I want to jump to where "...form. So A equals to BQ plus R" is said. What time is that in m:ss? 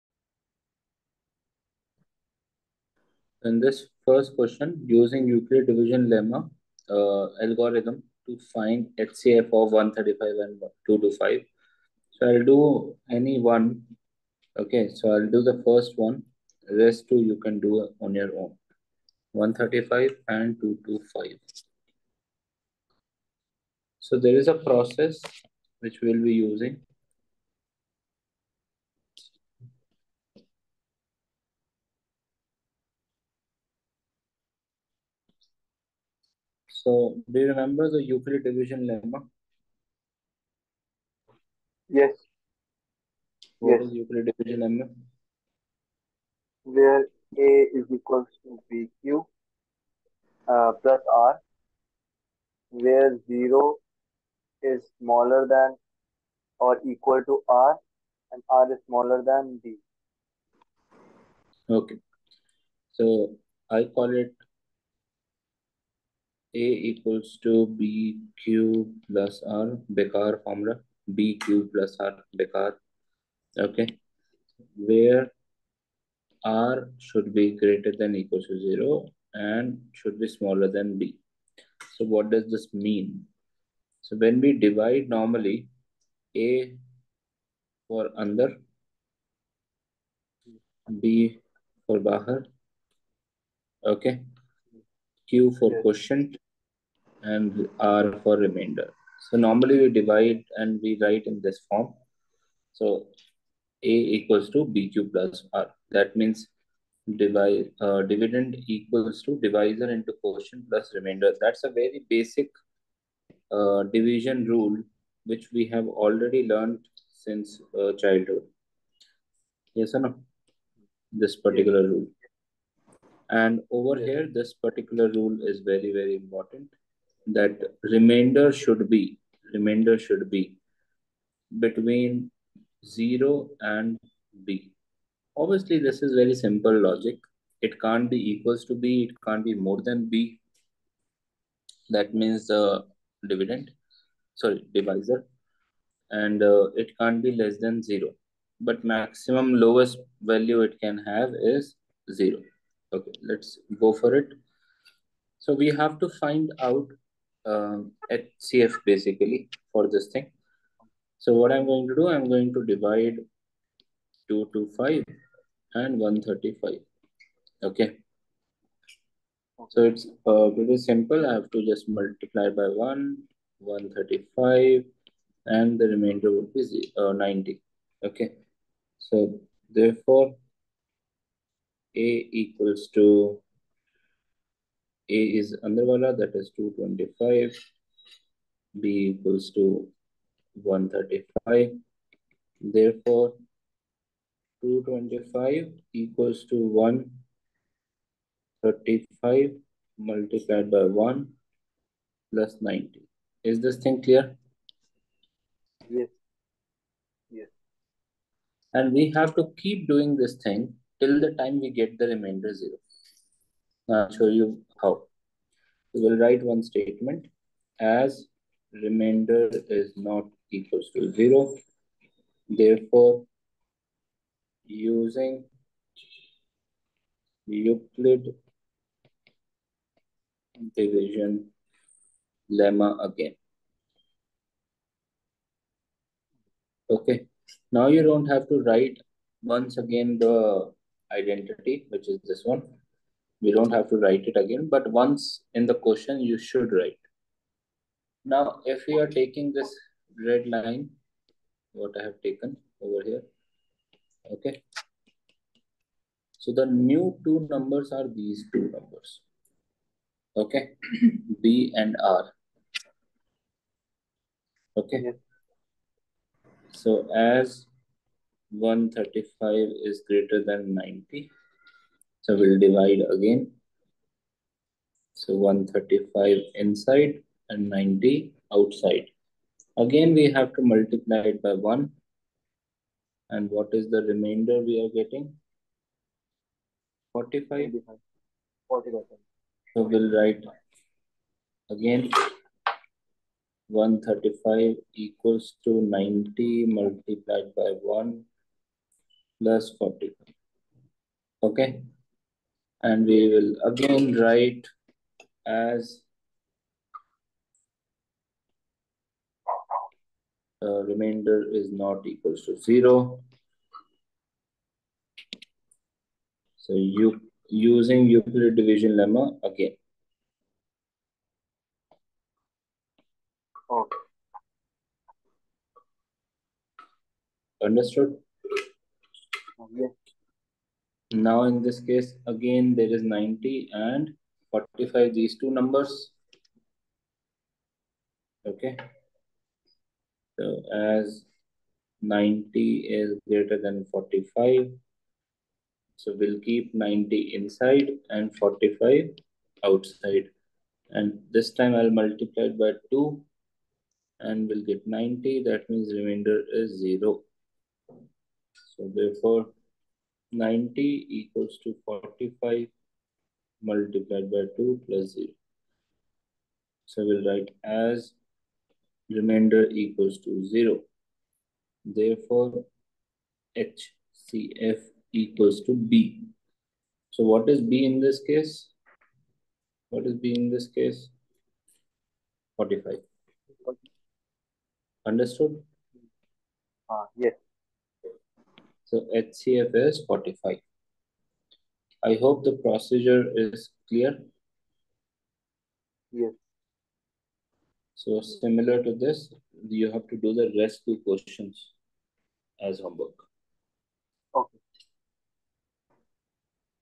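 1:41.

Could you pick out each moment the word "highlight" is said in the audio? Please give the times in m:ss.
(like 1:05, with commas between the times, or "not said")
not said.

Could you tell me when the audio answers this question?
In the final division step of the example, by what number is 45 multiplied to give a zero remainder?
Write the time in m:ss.
5:51.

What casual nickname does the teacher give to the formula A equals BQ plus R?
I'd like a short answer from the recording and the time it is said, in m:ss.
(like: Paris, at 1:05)
bekar formula, at 1:09.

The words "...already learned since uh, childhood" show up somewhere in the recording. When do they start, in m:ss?
1:55.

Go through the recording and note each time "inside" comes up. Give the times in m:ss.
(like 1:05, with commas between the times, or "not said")
4:36, 5:47.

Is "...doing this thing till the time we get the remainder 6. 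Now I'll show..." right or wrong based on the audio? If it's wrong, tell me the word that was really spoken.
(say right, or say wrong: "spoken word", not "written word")
wrong: "0", not "6".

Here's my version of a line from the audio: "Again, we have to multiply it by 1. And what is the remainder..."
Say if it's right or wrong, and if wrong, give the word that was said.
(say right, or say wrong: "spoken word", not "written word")
right.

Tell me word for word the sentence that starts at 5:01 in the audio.
Okay and we will again write as uh, remainder is not equals to 0.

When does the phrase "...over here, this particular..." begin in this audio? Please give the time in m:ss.
2:03.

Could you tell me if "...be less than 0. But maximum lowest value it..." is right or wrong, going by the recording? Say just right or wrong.
right.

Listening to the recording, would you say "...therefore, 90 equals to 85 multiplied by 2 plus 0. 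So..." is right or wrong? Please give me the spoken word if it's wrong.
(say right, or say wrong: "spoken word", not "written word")
wrong: "45", not "85".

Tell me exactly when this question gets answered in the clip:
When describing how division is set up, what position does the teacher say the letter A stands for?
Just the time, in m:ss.
1:26.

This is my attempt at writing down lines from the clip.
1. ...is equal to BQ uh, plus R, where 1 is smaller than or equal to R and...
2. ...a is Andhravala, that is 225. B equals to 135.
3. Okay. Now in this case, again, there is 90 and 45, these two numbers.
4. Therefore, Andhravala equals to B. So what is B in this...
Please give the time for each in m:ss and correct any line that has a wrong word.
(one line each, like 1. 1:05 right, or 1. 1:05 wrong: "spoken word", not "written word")
1. 0:47 wrong: "0", not "1"
2. 3:05 right
3. 5:29 right
4. 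6:11 wrong: "HCF", not "Andhravala".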